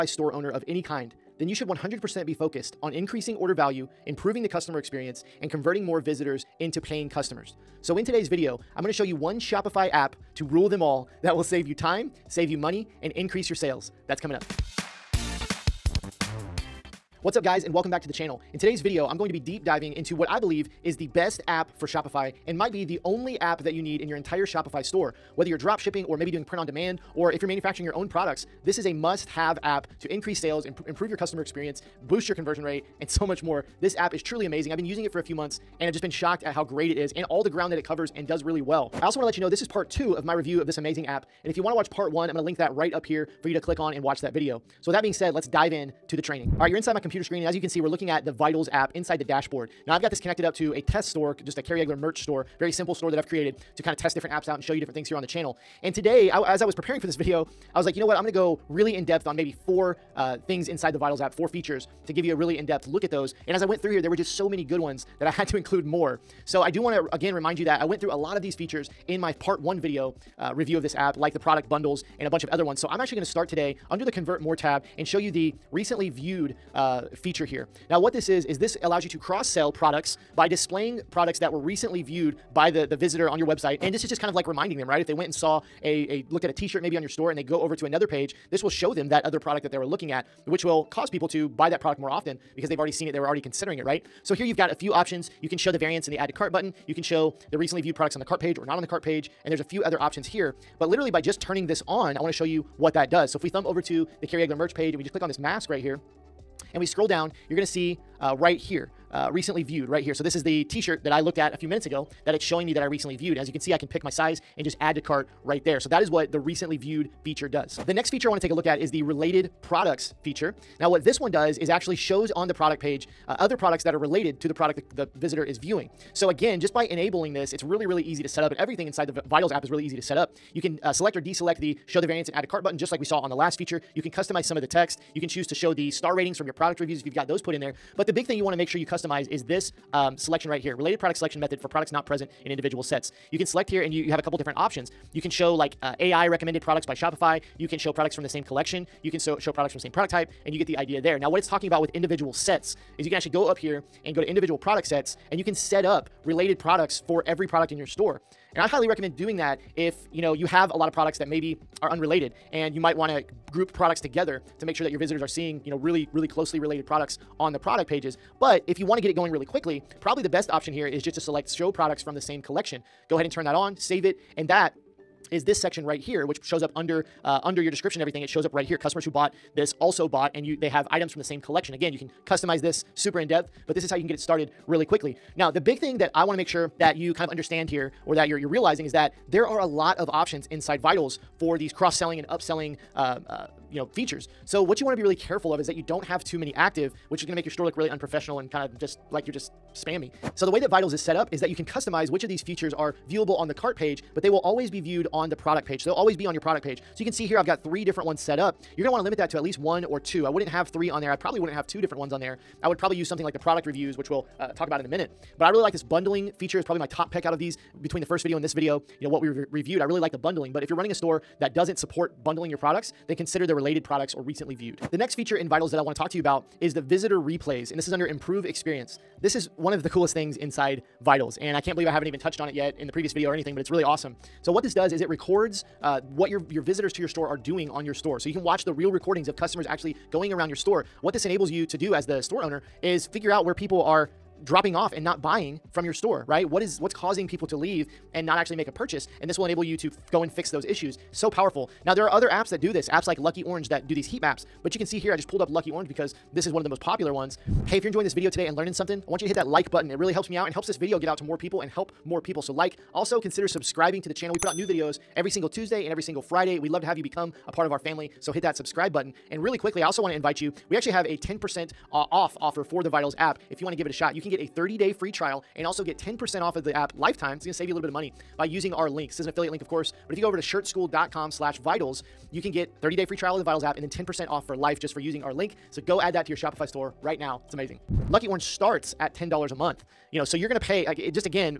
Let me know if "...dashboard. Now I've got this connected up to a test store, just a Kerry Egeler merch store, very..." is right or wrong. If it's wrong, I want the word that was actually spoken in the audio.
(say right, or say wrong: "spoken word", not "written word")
right.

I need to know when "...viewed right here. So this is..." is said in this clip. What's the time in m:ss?
1:49.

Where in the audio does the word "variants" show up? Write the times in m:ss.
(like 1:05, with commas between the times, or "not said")
1:35, 2:12.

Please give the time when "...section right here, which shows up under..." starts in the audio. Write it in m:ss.
2:55.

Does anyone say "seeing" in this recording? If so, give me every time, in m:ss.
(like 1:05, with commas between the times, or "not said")
2:45.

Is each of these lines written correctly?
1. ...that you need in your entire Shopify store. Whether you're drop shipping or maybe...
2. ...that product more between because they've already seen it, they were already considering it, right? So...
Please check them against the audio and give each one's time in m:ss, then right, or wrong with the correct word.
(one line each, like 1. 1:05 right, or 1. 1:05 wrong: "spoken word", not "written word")
1. 0:23 right
2. 1:31 wrong: "often", not "between".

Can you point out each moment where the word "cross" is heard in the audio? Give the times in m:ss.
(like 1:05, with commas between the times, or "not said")
1:19, 3:11.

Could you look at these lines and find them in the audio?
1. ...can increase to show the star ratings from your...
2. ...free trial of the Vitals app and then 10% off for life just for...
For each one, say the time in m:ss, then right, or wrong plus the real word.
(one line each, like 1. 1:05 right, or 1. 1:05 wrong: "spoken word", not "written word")
1. 2:15 wrong: "choose", not "increase"
2. 4:43 right.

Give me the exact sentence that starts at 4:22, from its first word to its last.
So like, also consider subscribing to the channel.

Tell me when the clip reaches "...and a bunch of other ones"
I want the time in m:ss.
1:12.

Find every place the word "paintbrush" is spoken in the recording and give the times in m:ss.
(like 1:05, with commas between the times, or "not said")
not said.